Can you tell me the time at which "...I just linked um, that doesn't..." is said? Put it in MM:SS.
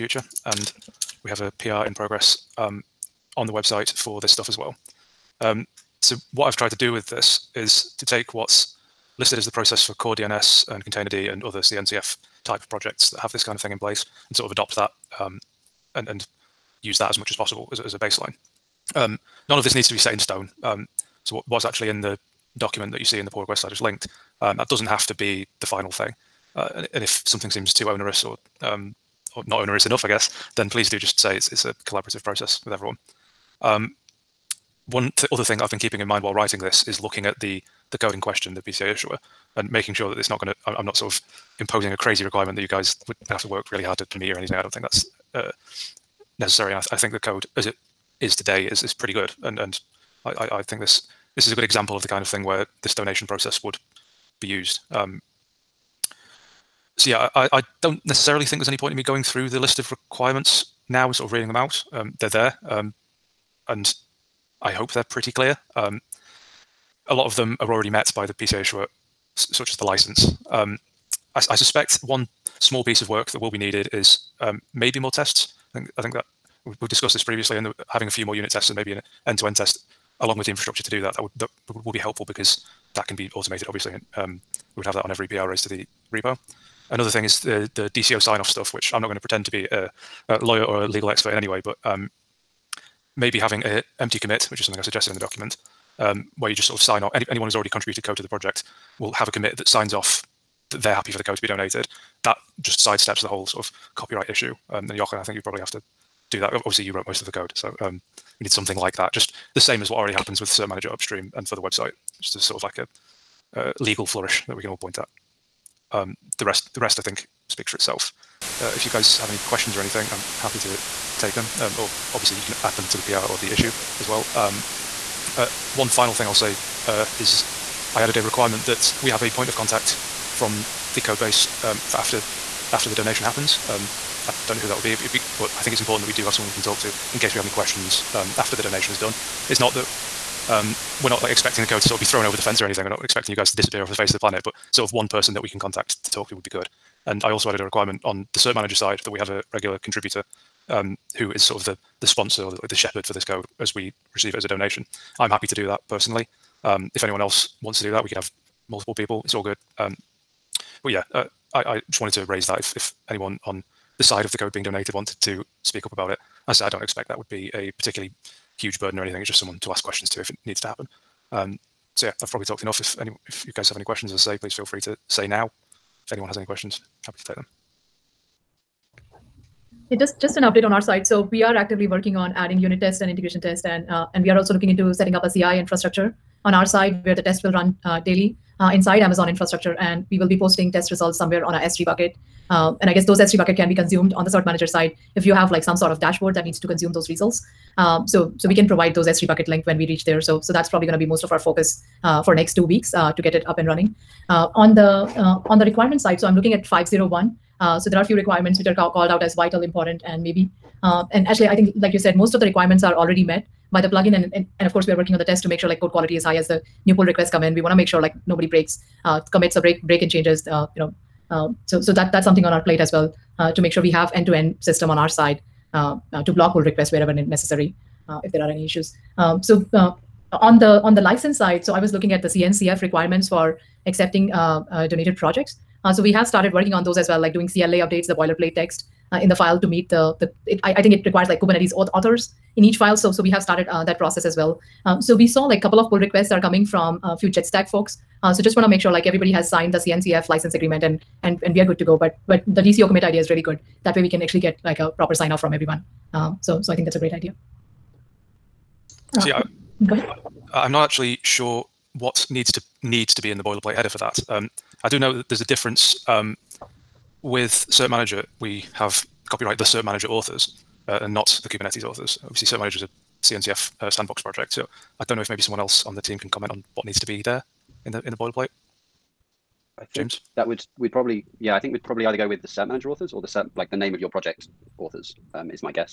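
00:23.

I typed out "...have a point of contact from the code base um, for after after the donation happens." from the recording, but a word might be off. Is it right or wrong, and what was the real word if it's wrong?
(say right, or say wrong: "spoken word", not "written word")
right.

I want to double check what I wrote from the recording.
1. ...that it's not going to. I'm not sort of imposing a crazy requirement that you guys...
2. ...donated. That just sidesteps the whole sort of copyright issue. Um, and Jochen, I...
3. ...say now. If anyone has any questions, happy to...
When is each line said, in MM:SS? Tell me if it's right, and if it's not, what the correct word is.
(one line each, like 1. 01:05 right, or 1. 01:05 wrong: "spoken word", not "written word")
1. 00:40 right
2. 01:41 right
3. 02:55 right.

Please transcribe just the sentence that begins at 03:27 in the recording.
Uh, so there are a few requirements which are ca called out as vital, important, and maybe.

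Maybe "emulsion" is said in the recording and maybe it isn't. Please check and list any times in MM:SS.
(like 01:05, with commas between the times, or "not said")
not said.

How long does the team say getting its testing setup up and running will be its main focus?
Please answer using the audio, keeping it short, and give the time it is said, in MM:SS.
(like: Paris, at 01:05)
2 weeks, at 03:22.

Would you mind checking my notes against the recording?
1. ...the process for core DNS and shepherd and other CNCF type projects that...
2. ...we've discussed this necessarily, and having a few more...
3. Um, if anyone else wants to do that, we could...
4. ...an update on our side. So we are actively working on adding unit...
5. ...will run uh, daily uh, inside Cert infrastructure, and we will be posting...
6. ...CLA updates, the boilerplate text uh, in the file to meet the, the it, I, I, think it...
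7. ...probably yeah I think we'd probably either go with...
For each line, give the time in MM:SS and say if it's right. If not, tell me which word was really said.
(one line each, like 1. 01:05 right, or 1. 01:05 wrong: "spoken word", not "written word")
1. 00:09 wrong: "containerd", not "shepherd"
2. 01:16 wrong: "previously", not "necessarily"
3. 02:36 right
4. 03:00 right
5. 03:07 wrong: "Amazon", not "Cert"
6. 03:57 right
7. 04:40 right.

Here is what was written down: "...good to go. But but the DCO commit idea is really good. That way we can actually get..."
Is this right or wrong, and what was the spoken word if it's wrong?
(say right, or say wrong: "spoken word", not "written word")
right.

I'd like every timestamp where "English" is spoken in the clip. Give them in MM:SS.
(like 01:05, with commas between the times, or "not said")
not said.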